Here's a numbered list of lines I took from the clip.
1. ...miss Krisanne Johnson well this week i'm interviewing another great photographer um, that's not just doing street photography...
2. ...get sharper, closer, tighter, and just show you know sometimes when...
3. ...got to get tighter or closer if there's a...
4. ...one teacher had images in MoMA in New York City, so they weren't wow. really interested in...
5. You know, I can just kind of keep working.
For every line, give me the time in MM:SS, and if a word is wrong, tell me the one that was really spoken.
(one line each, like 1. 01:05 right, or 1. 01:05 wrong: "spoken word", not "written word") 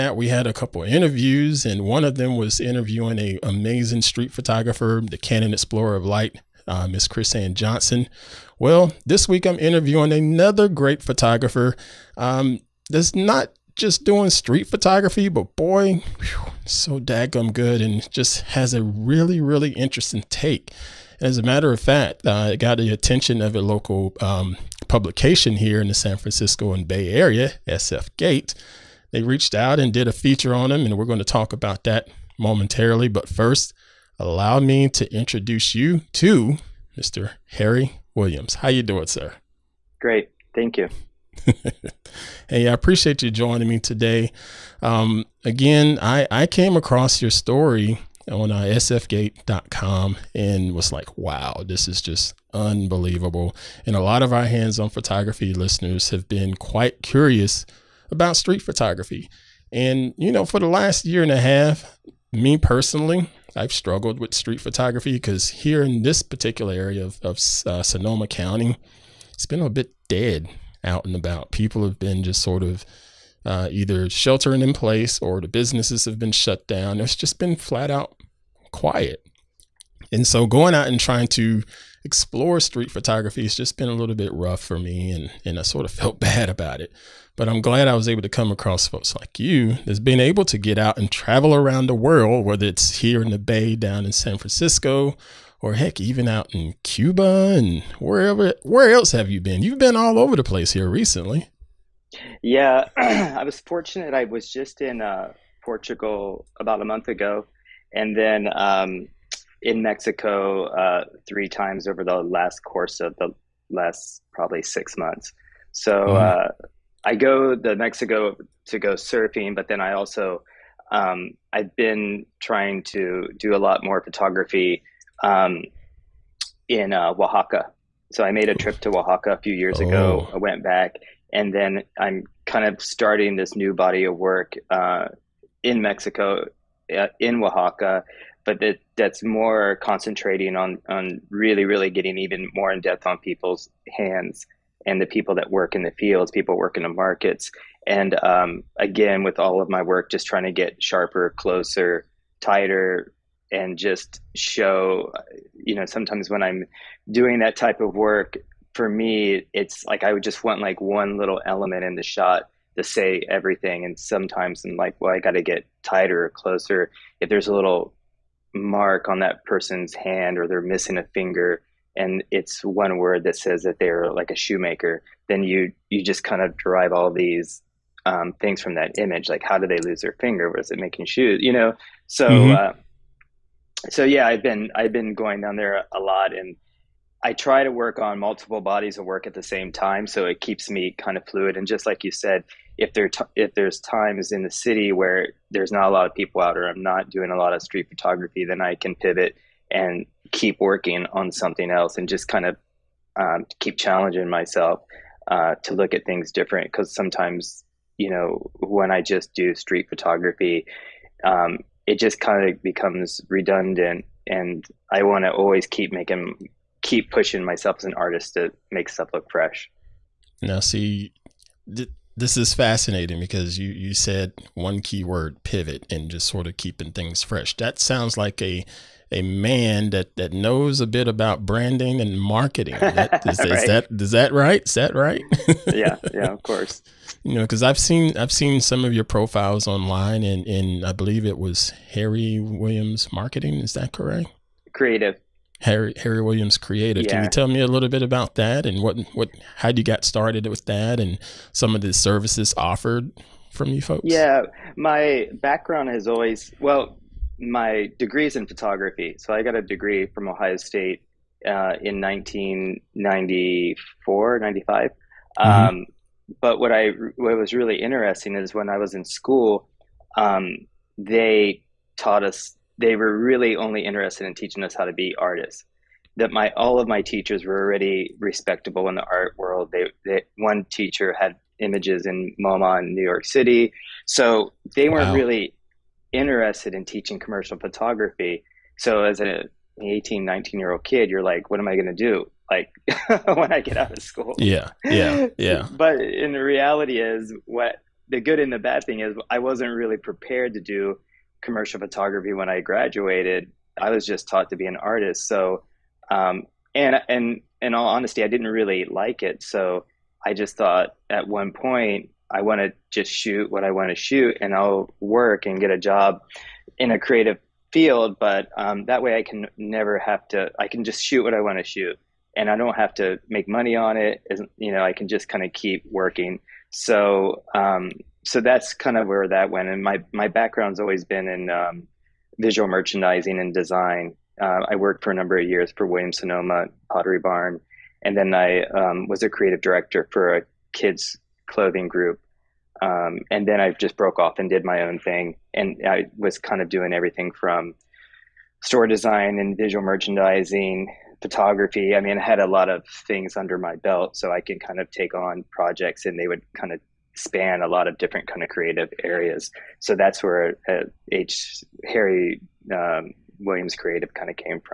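1. 00:06 right
2. 02:30 right
3. 02:45 right
4. 04:40 right
5. 05:24 right.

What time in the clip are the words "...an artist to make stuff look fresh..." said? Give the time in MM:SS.
03:37.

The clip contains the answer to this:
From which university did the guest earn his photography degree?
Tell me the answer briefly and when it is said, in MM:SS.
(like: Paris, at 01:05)
Ohio State, at 04:20.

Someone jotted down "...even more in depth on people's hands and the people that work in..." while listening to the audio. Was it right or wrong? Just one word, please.
right.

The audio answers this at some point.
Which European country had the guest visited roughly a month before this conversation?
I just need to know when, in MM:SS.
01:45.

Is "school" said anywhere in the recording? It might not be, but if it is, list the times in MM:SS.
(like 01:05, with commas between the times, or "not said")
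04:29, 04:54.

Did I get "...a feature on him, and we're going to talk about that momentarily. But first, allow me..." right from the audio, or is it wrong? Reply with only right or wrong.
right.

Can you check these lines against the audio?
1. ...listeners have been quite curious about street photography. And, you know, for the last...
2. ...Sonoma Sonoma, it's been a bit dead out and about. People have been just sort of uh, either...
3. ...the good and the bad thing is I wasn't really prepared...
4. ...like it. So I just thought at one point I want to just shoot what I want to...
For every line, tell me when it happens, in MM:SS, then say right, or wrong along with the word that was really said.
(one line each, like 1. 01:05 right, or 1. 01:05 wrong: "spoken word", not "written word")
1. 00:55 right
2. 01:07 wrong: "County", not "Sonoma"
3. 04:58 right
4. 05:08 right.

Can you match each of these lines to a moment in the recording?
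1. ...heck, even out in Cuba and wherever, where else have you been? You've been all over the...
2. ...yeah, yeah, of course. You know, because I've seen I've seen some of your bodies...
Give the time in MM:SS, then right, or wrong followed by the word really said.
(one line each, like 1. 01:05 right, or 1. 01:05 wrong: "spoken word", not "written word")
1. 01:35 right
2. 03:55 wrong: "profiles", not "bodies".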